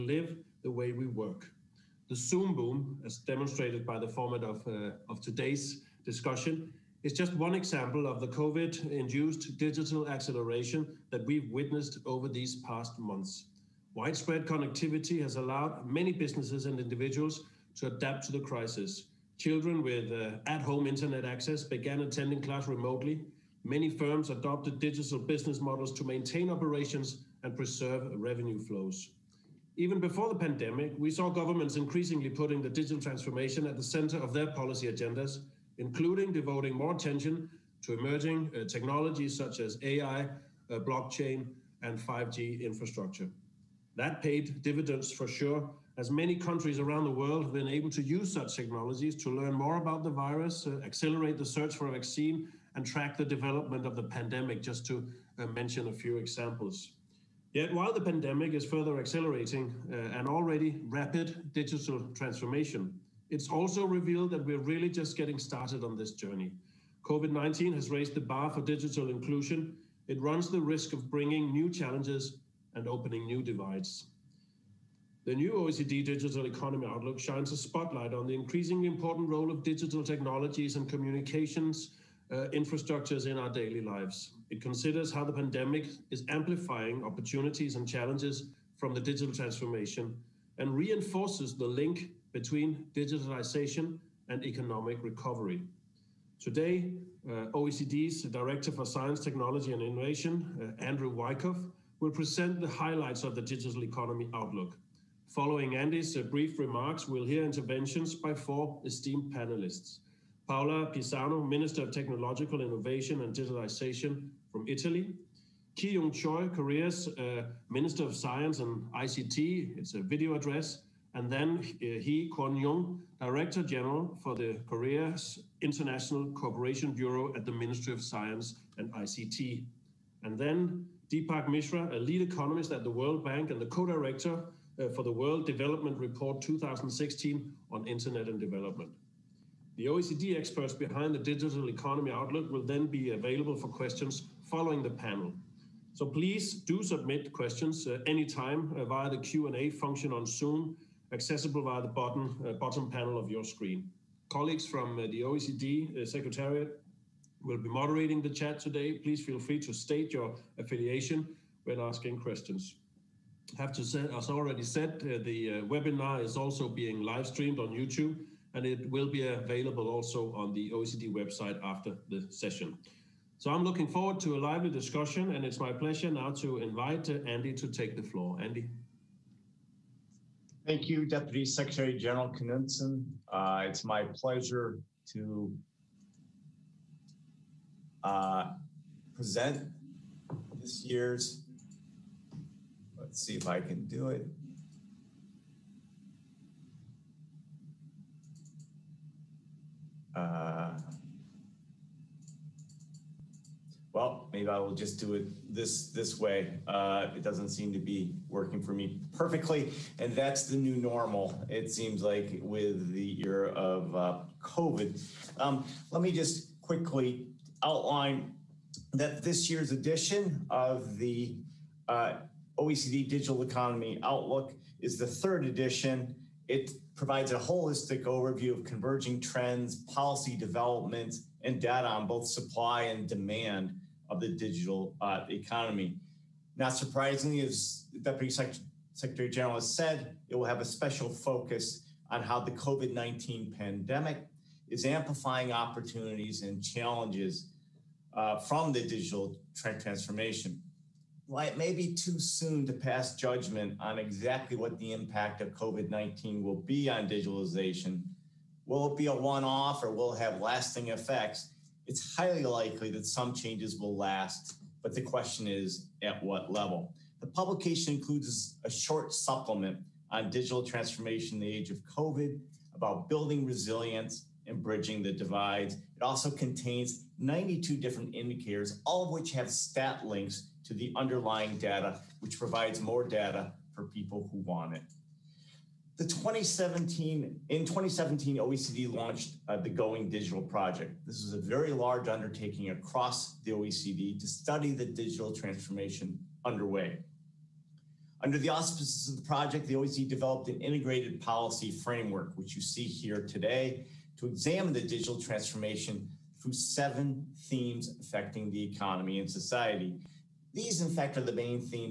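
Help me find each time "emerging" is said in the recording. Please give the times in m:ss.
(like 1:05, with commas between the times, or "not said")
0:37.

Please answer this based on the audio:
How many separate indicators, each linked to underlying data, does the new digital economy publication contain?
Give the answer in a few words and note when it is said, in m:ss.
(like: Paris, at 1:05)
92, at 4:37.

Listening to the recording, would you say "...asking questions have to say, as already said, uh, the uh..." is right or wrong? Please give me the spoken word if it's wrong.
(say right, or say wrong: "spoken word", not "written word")
right.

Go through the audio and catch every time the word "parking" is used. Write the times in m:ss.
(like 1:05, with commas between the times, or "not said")
not said.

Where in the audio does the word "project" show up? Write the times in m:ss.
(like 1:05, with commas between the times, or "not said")
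4:50, 4:59.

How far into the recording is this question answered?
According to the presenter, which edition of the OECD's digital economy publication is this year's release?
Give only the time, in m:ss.
3:45.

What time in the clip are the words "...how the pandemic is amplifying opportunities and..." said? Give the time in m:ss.
1:25.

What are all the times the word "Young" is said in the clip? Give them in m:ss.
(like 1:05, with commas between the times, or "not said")
1:55, 2:02.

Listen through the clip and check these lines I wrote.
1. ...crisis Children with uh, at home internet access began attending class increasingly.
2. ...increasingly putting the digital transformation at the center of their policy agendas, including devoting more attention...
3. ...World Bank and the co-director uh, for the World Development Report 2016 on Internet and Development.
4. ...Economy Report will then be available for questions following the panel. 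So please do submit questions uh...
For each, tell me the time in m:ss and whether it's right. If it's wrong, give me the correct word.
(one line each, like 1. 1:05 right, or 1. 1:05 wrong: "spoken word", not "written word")
1. 0:18 wrong: "remotely", not "increasingly"
2. 0:31 right
3. 2:12 right
4. 2:21 wrong: "Outlook", not "Report".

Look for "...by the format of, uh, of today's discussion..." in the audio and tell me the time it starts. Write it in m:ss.
0:03.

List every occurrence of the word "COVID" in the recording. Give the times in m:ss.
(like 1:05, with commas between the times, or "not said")
0:08, 1:07, 3:34, 4:02, 4:15, 4:31.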